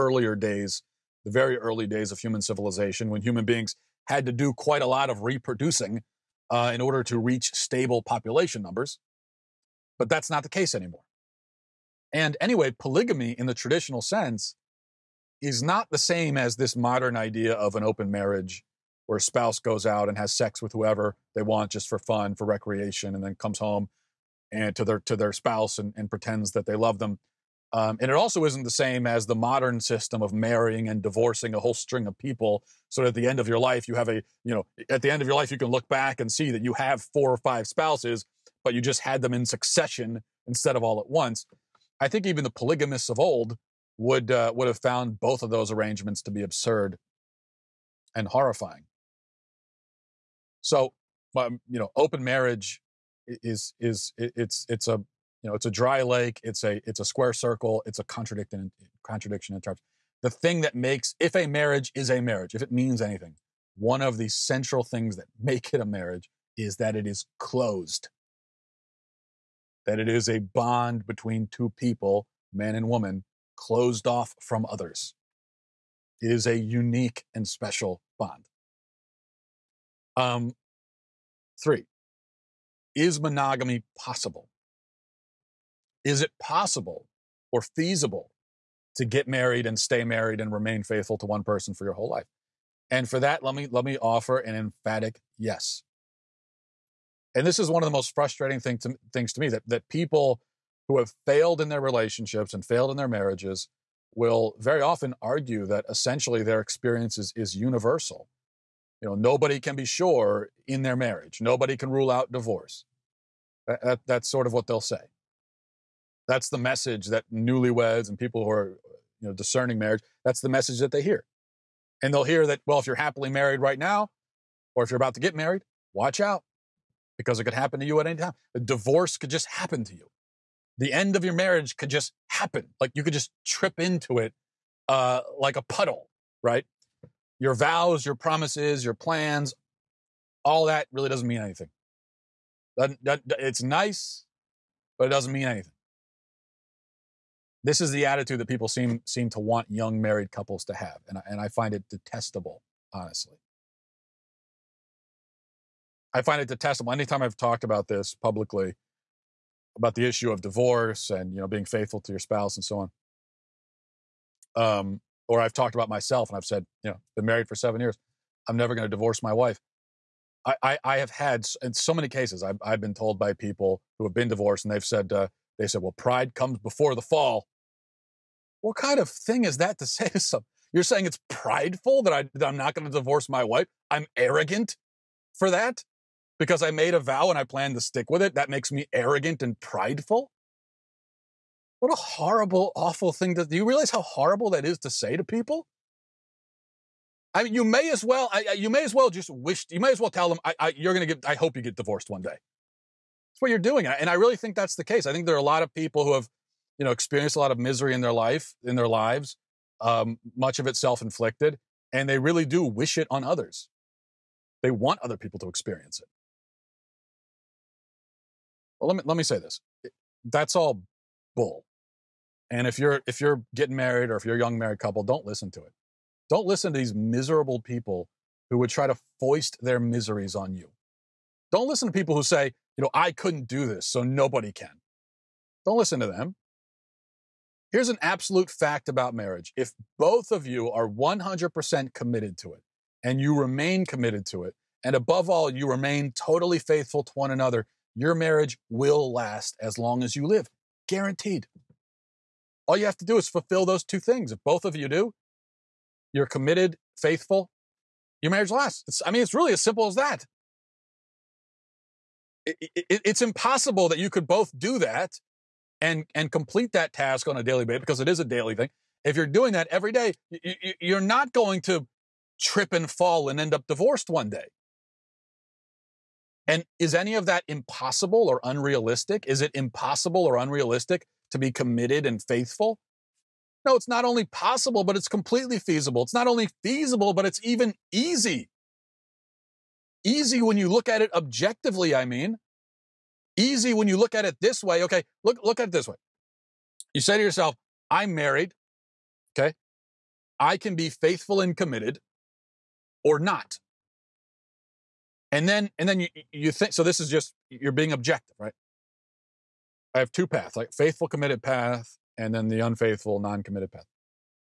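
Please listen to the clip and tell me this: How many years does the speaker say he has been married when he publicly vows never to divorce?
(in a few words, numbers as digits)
7.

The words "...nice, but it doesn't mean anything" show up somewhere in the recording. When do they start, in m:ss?
2:23.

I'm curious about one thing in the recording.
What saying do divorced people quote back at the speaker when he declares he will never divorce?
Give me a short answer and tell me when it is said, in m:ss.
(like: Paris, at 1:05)
Pride comes before the fall, at 2:55.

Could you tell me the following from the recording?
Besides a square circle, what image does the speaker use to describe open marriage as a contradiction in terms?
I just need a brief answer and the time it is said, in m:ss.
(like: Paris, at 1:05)
A dry lake, at 0:55.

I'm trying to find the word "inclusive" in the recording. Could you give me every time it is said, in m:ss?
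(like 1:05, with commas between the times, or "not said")
not said.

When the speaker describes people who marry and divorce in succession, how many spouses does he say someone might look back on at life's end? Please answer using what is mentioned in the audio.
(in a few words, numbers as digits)
4 or 5.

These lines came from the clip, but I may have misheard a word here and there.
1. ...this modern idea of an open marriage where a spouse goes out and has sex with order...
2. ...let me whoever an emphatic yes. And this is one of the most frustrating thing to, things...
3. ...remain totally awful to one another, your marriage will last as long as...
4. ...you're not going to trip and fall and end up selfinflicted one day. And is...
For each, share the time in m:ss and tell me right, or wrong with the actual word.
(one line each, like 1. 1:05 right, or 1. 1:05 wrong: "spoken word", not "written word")
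1. 0:16 wrong: "whoever", not "order"
2. 1:33 wrong: "offer", not "whoever"
3. 4:05 wrong: "faithful", not "awful"
4. 4:30 wrong: "divorced", not "selfinflicted".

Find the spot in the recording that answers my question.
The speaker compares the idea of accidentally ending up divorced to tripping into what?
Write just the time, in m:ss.
2:15.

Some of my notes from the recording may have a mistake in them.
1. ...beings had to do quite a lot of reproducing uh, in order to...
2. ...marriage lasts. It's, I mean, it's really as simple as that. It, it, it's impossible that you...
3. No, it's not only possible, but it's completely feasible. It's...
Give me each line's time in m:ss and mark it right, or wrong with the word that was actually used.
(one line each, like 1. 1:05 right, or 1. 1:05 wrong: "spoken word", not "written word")
1. 0:03 right
2. 4:18 right
3. 4:43 right.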